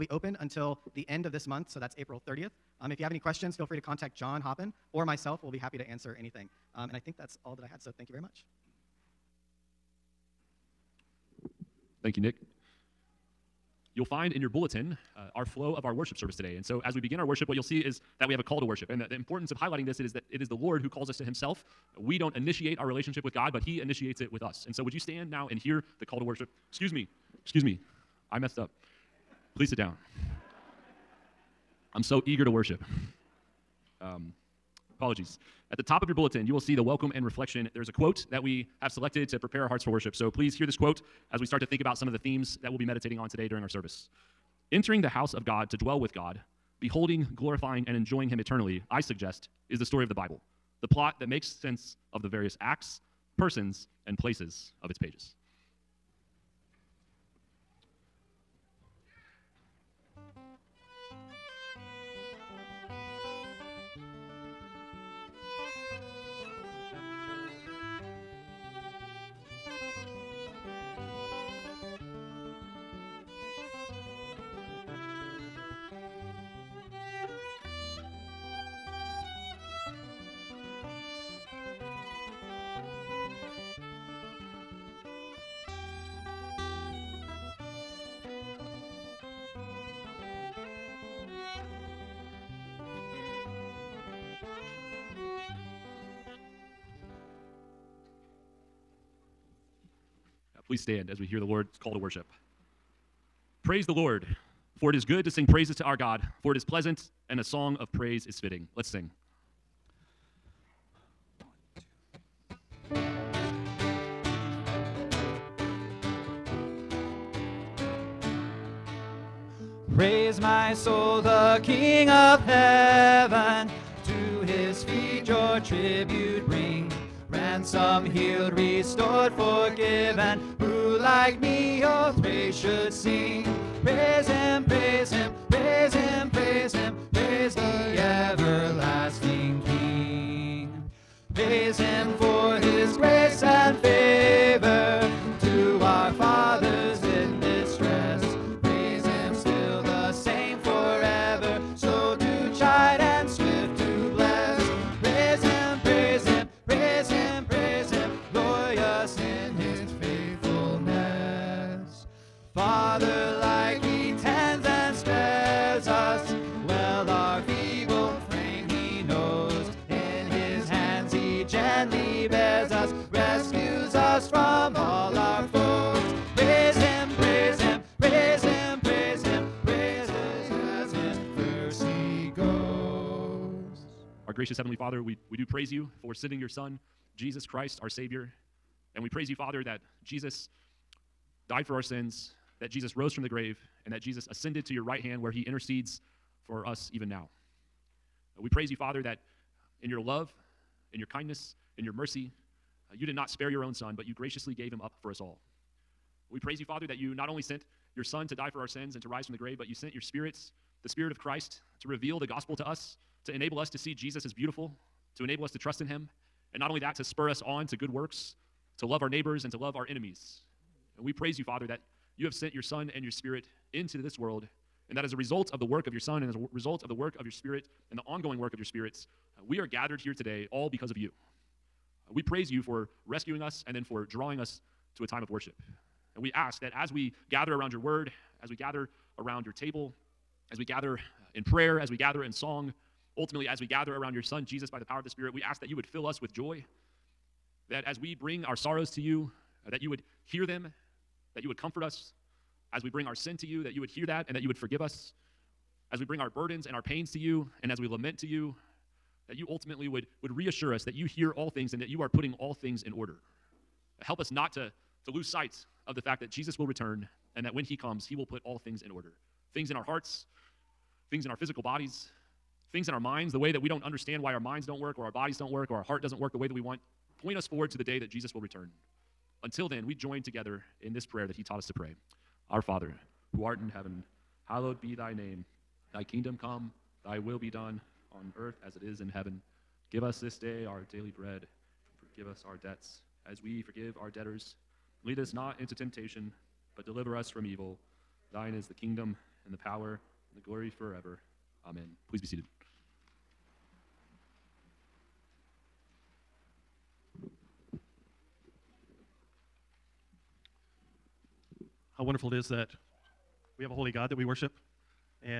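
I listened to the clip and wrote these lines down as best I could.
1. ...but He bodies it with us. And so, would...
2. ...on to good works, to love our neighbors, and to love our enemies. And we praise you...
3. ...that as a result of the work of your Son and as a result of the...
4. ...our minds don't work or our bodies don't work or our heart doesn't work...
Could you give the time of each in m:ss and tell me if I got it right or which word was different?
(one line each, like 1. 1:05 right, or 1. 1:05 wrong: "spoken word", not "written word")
1. 0:23 wrong: "initiates", not "bodies"
2. 3:37 right
3. 3:44 right
4. 4:34 right.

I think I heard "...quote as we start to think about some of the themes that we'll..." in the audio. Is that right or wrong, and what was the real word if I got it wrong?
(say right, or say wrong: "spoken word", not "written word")
right.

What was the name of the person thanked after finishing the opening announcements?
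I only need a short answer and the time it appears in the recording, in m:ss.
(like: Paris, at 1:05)
Nick, at 0:12.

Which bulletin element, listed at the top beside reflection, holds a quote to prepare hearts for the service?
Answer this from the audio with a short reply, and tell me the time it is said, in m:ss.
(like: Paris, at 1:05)
welcome, at 0:36.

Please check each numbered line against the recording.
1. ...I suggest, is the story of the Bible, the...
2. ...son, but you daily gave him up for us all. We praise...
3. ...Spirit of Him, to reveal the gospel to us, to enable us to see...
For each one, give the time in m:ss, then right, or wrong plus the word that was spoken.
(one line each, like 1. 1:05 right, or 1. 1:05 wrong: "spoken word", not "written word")
1. 0:48 right
2. 3:23 wrong: "graciously", not "daily"
3. 3:30 wrong: "Christ", not "Him".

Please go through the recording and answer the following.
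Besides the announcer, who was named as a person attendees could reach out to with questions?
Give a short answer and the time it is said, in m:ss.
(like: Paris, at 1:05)
John Hoppin, at 0:04.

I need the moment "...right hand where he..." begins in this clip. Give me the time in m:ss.
3:14.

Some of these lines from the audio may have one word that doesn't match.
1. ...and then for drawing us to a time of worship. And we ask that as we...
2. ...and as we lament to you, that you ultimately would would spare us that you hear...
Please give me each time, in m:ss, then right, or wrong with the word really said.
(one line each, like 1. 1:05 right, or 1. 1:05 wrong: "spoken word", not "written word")
1. 3:53 right
2. 4:17 wrong: "reassure", not "spare".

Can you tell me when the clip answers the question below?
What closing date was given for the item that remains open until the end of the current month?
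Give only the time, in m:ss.
0:01.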